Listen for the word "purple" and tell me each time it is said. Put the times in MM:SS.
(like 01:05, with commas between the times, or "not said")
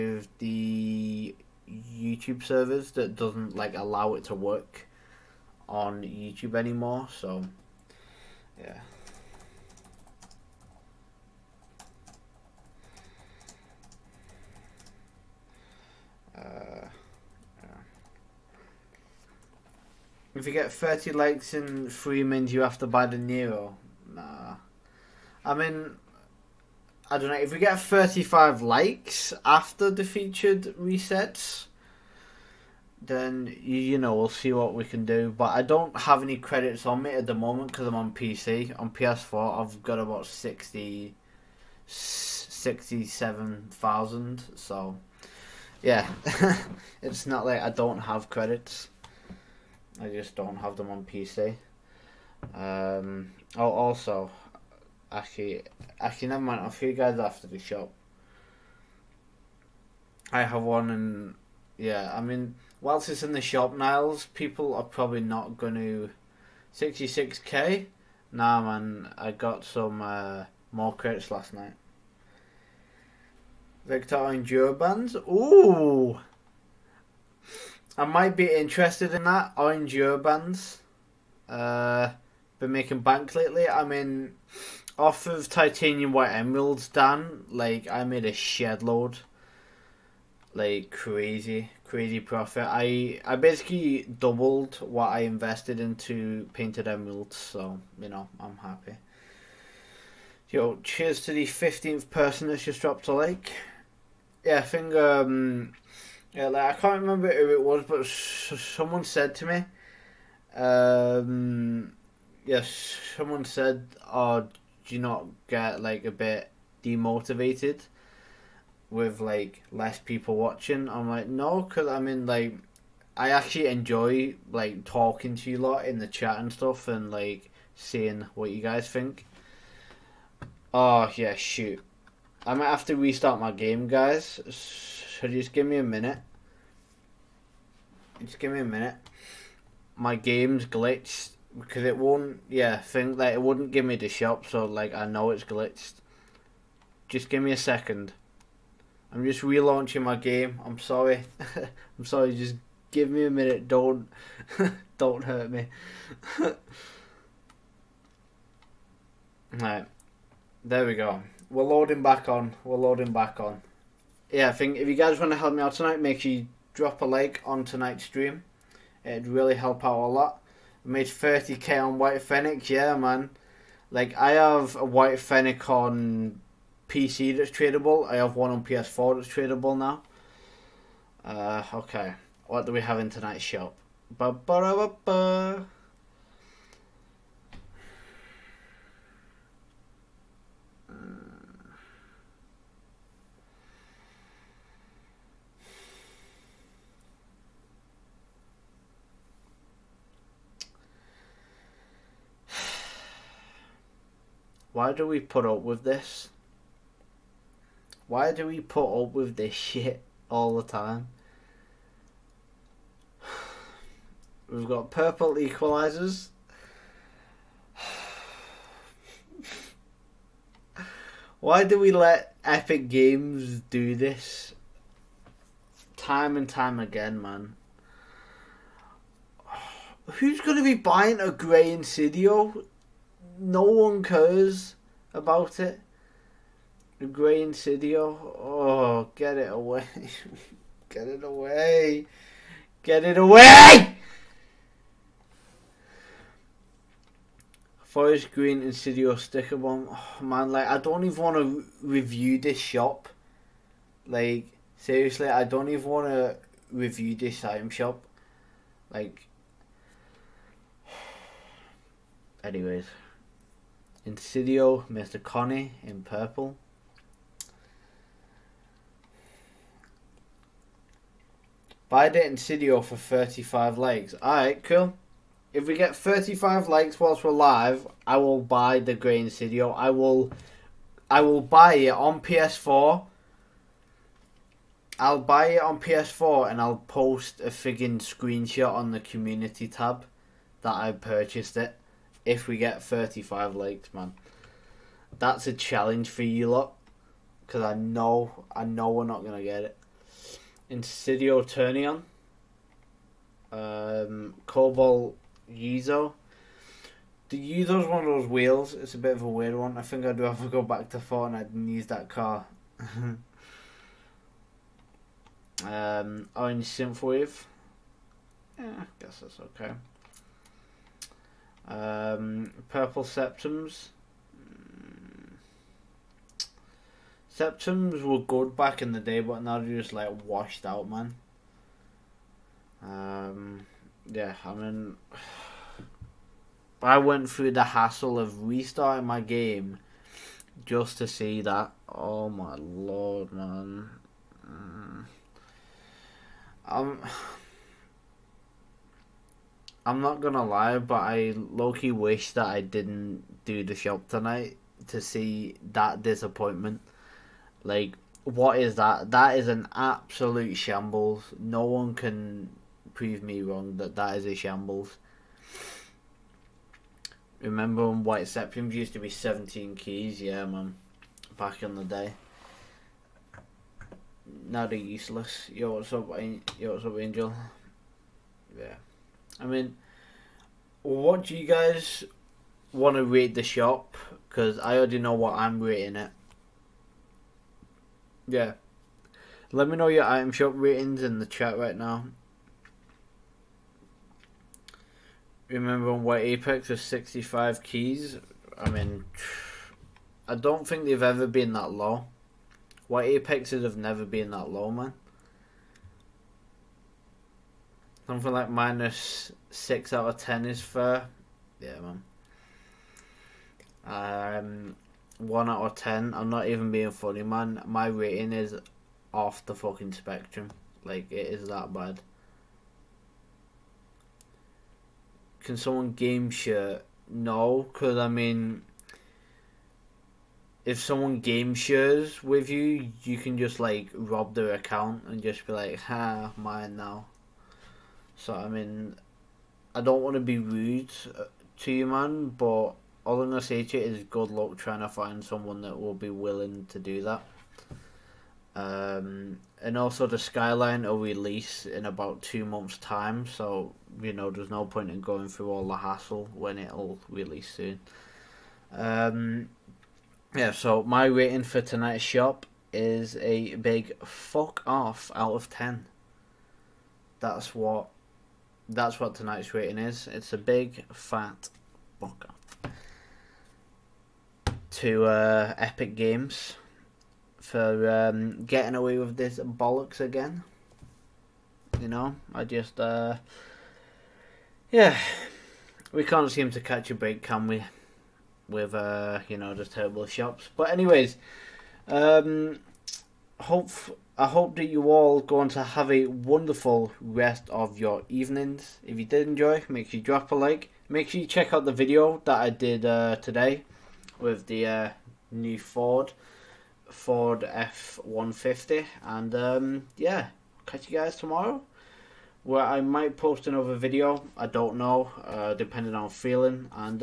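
03:34, 04:26, 05:22.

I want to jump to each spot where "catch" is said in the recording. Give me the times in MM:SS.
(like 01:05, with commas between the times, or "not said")
08:06, 08:30.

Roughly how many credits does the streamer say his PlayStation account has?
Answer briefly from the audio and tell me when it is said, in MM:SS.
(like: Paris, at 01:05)
67,000, at 00:41.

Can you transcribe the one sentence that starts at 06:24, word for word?
Because I already know what I'm rating it.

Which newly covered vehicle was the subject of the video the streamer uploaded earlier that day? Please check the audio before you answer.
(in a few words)
Ford F-150.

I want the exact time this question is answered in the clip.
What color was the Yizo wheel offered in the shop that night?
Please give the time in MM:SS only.
05:04.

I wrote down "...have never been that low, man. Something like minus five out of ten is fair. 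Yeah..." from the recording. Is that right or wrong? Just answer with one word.
wrong.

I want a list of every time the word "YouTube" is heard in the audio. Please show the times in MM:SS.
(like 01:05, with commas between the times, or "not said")
00:01, 00:06.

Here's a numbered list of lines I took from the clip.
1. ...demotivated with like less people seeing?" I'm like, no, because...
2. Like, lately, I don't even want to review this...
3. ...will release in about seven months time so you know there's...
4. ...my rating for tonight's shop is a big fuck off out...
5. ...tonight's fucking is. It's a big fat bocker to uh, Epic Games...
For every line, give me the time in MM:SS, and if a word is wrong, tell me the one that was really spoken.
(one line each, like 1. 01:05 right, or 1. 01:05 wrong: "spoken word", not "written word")
1. 01:56 wrong: "watching", not "seeing"
2. 04:14 wrong: "seriously", not "lately"
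3. 07:30 wrong: "two", not "seven"
4. 07:40 right
5. 07:49 wrong: "rating", not "fucking".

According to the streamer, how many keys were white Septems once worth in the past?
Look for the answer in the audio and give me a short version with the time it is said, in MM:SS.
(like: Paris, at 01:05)
17 keys, at 06:09.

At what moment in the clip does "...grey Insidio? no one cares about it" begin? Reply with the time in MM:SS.
03:51.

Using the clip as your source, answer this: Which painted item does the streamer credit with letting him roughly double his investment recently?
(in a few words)
Titanium white emeralds.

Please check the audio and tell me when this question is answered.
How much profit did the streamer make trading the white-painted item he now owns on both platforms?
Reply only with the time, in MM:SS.
02:51.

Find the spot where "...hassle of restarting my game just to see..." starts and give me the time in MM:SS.
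05:37.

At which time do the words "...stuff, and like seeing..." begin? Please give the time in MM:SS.
02:06.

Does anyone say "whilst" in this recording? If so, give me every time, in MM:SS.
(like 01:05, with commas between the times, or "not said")
01:02, 04:36.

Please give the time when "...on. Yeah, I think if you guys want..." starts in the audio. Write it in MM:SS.
02:43.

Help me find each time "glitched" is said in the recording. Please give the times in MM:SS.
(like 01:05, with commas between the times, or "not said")
02:20, 02:25.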